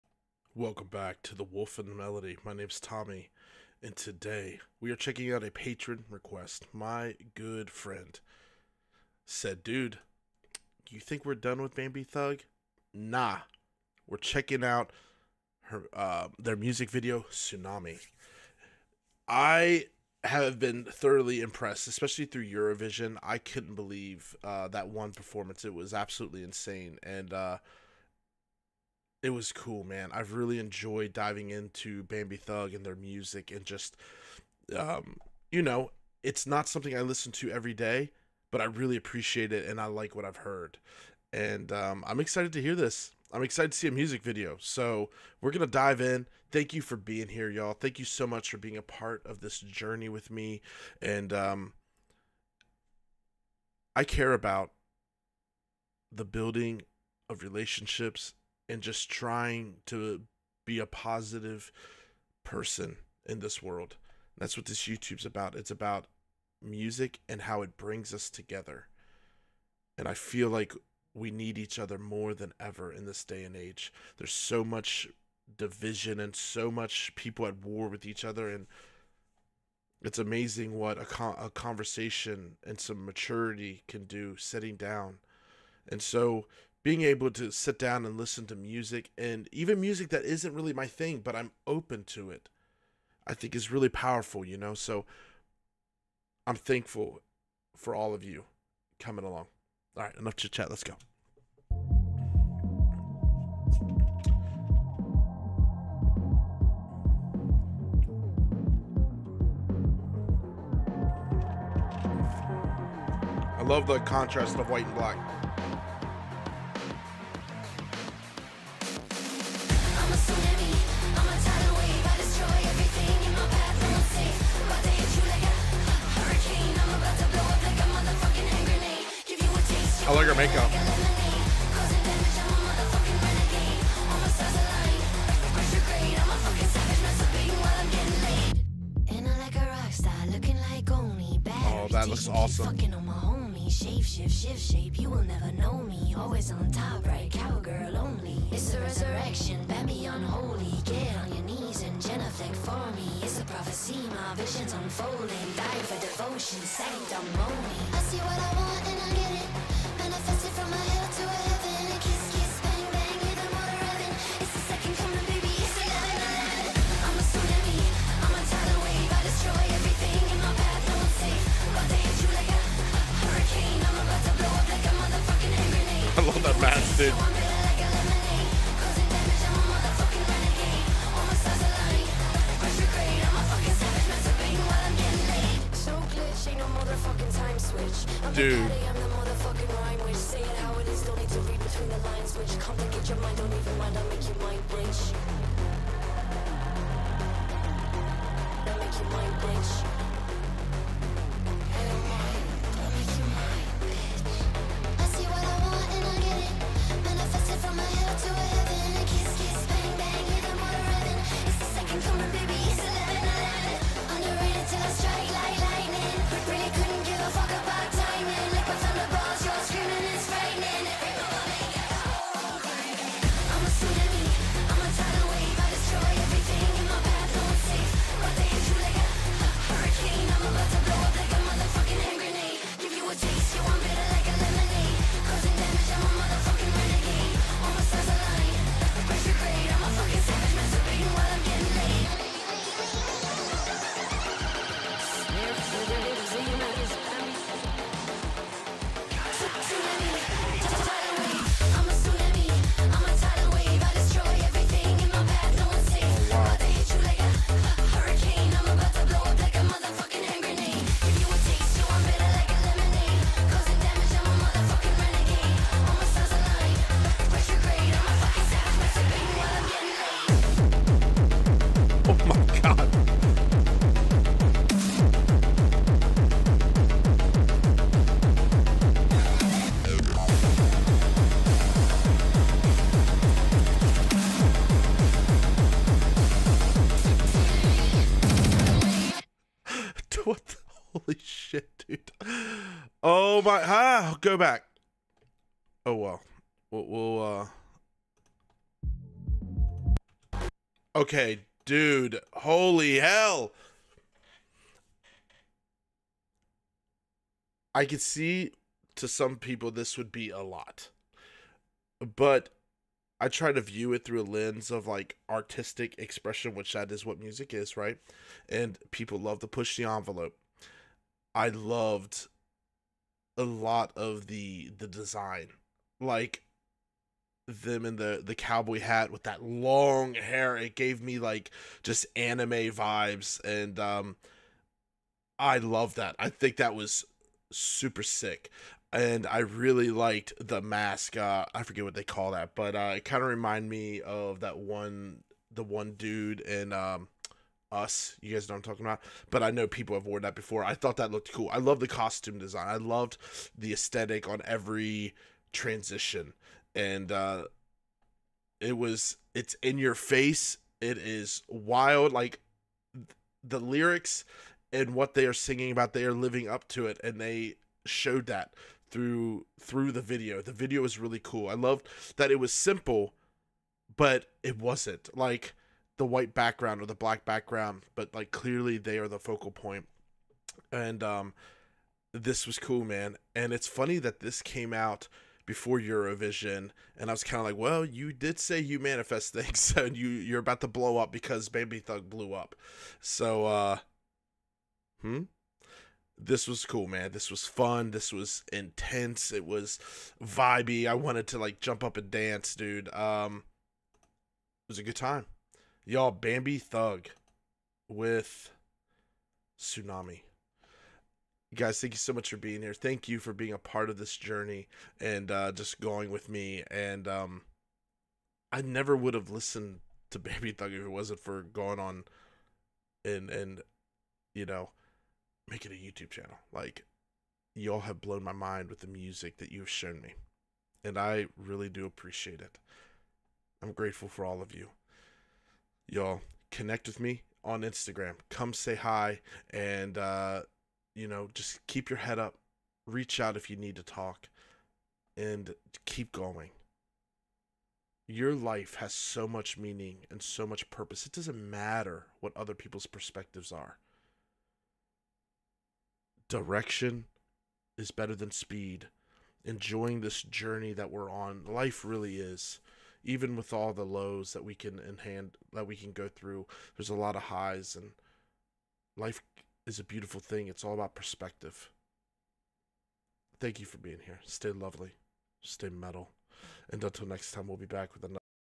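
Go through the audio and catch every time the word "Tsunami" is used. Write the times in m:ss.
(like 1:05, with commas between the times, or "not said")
0:17, 6:49.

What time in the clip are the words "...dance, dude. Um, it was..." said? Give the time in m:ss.
6:42.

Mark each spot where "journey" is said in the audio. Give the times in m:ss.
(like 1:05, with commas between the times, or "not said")
0:49, 6:54, 7:40.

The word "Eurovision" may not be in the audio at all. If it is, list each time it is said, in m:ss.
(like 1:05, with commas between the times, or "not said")
0:22, 6:25.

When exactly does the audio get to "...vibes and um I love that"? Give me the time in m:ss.
5:32.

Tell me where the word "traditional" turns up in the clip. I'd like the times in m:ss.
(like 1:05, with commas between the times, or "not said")
not said.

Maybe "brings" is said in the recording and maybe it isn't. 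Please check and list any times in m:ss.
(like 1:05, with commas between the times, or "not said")
1:07.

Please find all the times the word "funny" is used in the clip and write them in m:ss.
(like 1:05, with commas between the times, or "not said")
6:23.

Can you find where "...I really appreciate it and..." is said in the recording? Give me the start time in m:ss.
0:38.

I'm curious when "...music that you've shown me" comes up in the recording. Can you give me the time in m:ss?
7:08.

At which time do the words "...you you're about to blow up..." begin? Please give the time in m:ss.
6:29.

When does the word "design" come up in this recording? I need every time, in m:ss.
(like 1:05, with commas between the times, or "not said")
5:24, 5:52.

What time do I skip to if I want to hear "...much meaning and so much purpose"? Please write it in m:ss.
7:29.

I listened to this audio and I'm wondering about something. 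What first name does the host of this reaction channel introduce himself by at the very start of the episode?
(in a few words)
Tommy.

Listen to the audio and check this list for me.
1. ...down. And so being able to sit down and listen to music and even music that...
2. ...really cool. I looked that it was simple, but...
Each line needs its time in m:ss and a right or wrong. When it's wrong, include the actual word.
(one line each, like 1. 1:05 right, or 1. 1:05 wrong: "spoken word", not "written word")
1. 1:24 right
2. 6:10 wrong: "loved", not "looked".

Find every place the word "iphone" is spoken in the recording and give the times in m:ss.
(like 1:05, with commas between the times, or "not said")
not said.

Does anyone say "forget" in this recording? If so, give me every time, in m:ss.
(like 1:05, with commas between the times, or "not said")
5:41.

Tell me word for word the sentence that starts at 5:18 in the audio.
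And people love to push the envelope.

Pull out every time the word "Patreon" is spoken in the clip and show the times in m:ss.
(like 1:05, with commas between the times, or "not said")
0:05.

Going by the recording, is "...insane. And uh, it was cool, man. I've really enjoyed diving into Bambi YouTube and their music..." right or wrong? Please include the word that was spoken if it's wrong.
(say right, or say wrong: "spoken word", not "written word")
wrong: "Thug", not "YouTube".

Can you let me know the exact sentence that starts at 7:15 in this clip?
Y'all, connect with me on Instagram.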